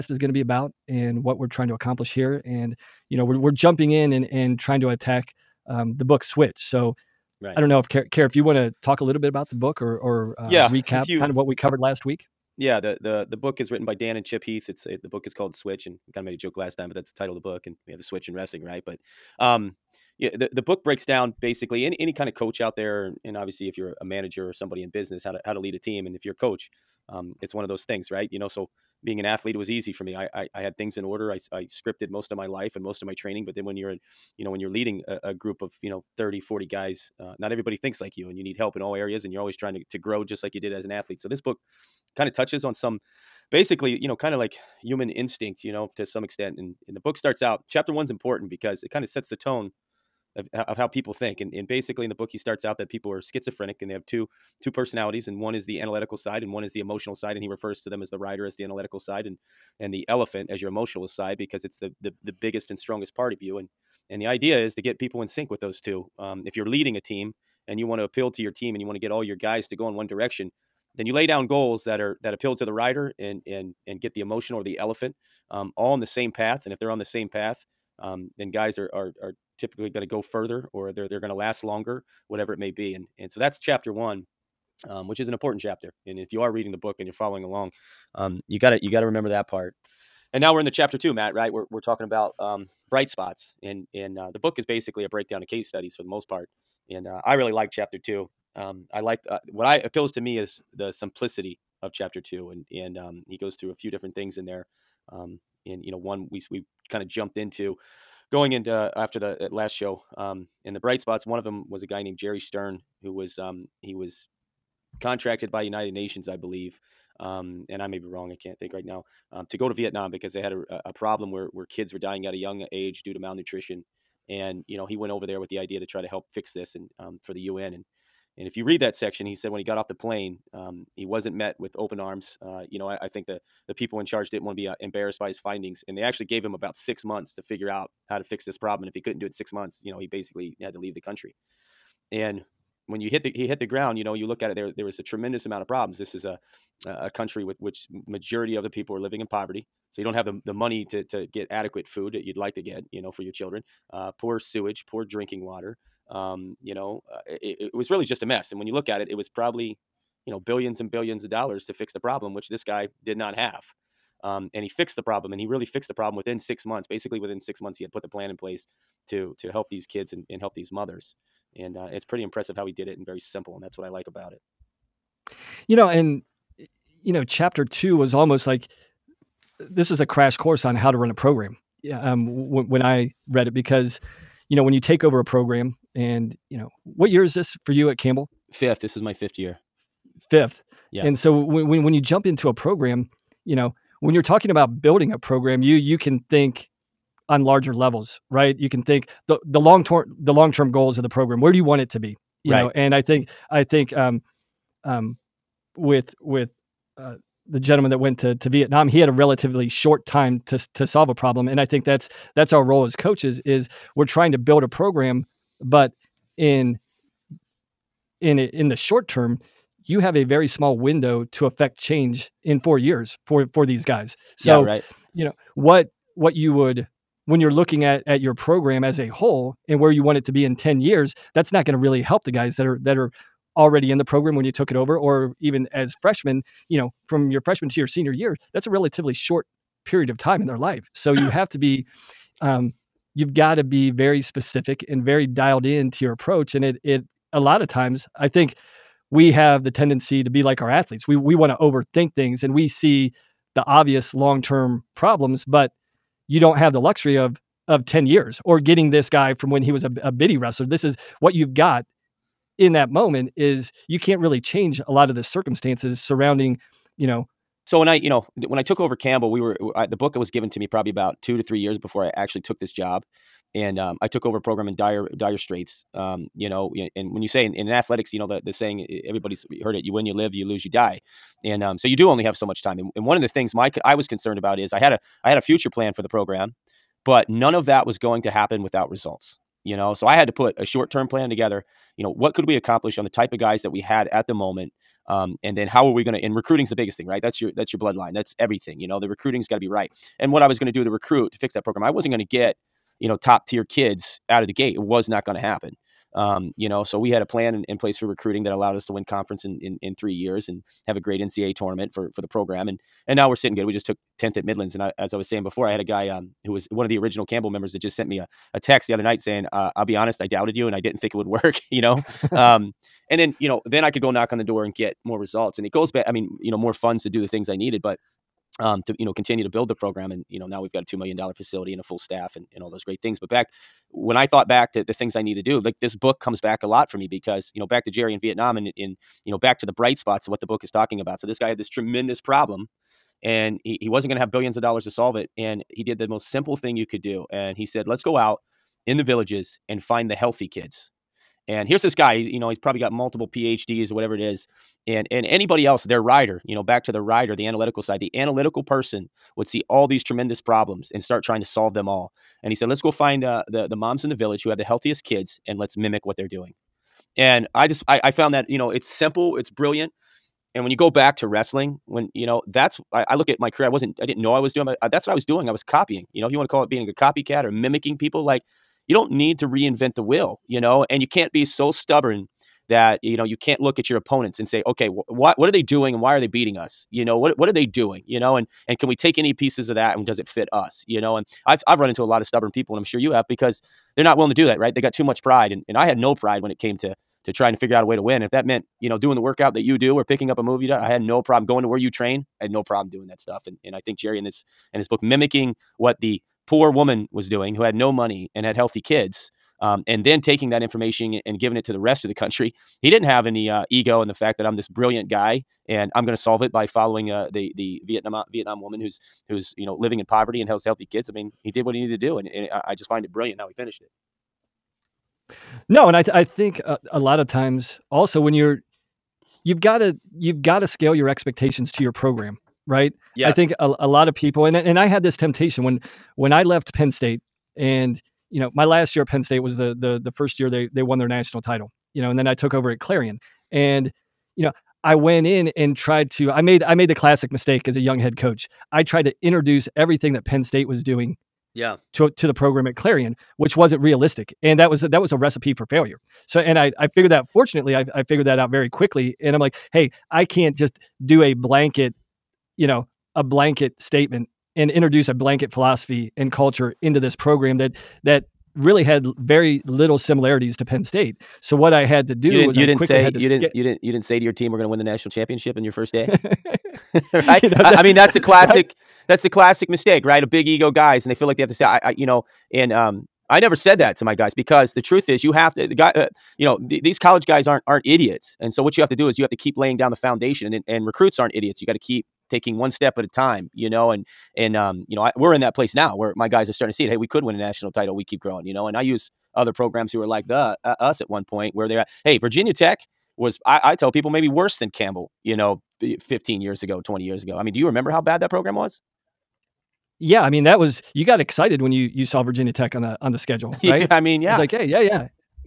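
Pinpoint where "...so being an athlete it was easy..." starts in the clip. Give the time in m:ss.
0:28.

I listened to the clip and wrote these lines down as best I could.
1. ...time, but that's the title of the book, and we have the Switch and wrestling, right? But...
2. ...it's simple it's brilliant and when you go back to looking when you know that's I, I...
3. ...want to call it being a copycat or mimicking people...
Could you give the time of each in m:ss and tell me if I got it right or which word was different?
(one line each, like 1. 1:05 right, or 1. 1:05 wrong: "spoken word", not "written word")
1. 0:16 right
2. 6:08 wrong: "wrestling", not "looking"
3. 6:16 right.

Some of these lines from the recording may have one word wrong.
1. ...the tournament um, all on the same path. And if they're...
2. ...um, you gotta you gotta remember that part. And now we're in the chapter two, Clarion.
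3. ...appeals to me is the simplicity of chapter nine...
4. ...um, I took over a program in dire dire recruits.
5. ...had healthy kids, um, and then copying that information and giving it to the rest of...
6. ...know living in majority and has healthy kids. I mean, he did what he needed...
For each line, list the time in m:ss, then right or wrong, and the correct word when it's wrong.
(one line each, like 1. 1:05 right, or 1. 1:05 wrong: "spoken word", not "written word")
1. 1:14 wrong: "elephant", not "tournament"
2. 1:28 wrong: "Matt", not "Clarion"
3. 1:39 wrong: "two", not "nine"
4. 4:33 wrong: "straits", not "recruits"
5. 6:48 wrong: "taking", not "copying"
6. 6:59 wrong: "poverty", not "majority".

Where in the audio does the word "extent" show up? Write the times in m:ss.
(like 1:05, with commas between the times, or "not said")
0:46.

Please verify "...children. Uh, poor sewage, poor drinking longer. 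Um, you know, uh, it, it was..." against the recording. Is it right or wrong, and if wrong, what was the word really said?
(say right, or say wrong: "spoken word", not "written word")
wrong: "water", not "longer".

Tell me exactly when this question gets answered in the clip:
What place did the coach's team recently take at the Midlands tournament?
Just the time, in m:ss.
5:14.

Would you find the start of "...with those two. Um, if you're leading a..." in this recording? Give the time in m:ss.
1:05.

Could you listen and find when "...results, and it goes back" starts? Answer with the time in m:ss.
5:25.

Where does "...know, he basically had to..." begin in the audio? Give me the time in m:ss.
2:19.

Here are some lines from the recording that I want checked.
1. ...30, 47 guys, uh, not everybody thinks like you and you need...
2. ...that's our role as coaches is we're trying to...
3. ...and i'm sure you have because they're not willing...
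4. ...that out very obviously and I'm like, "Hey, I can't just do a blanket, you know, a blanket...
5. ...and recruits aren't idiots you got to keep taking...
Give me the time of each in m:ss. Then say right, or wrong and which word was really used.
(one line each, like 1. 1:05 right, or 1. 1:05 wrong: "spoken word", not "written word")
1. 0:36 wrong: "40", not "47"
2. 3:32 right
3. 6:32 right
4. 7:38 wrong: "quickly", not "obviously"
5. 8:10 right.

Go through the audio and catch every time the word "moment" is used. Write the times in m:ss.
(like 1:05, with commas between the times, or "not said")
4:22, 4:54.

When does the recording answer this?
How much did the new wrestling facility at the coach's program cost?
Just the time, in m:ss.
5:30.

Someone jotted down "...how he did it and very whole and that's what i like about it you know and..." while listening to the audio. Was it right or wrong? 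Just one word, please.
wrong.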